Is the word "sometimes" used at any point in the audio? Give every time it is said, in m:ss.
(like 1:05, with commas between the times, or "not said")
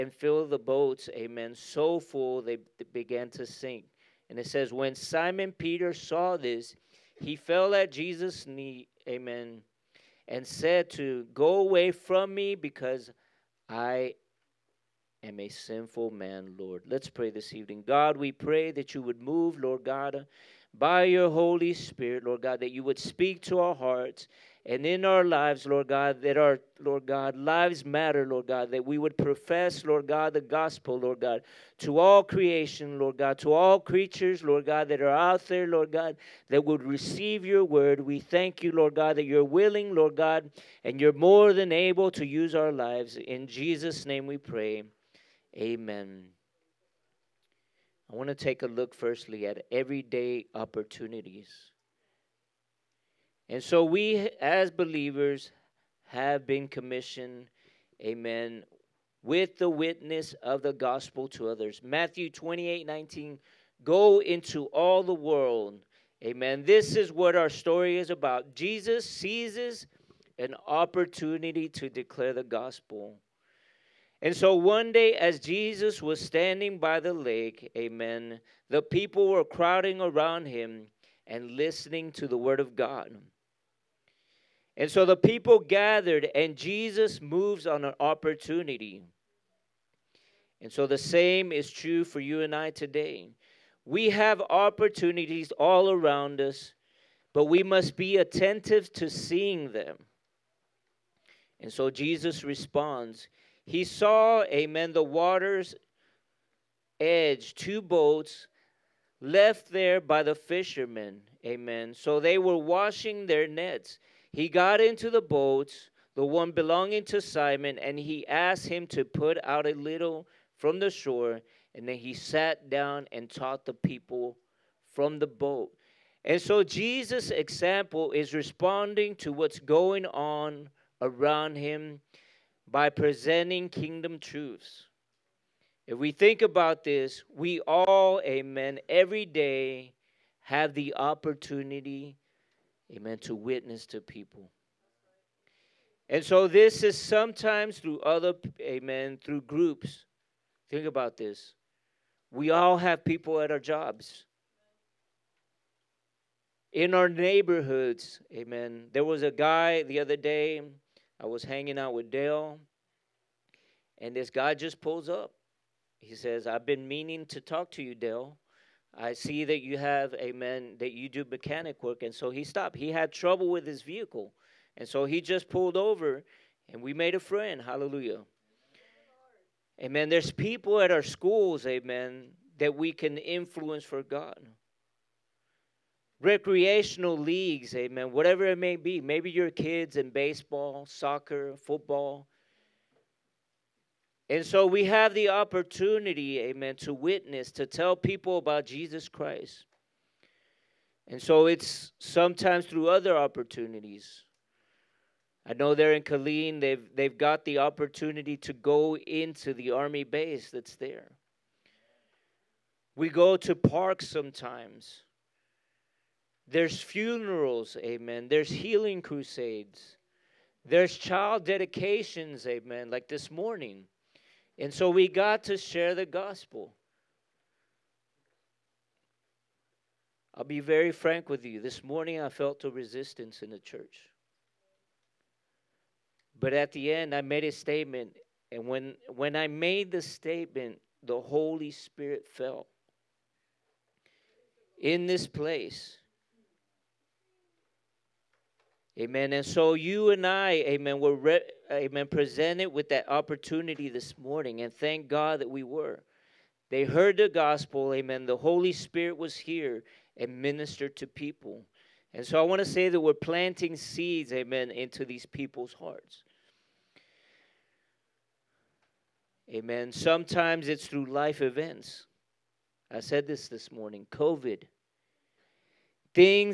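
2:26, 3:21, 3:34, 4:29.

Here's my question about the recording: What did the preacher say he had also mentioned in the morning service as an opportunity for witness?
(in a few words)
COVID.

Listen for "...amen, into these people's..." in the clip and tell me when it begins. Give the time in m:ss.
4:24.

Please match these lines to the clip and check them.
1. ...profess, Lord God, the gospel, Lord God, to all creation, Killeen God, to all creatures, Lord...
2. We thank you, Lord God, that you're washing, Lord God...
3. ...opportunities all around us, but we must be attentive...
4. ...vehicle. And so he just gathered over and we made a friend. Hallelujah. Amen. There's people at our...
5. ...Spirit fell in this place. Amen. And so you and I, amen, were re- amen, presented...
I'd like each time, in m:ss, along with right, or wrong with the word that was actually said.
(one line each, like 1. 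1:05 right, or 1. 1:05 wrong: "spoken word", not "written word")
1. 0:29 wrong: "Lord", not "Killeen"
2. 0:37 wrong: "willing", not "washing"
3. 1:34 right
4. 2:53 wrong: "pulled", not "gathered"
5. 4:01 right.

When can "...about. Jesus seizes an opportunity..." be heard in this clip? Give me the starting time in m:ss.
1:08.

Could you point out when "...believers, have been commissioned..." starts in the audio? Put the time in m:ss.
0:54.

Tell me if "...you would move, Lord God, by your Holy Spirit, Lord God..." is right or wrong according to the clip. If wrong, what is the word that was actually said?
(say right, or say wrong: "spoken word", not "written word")
right.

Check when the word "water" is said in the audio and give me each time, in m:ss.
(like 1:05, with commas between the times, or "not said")
1:45.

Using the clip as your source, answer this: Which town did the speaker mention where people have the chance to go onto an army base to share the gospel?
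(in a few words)
Killeen.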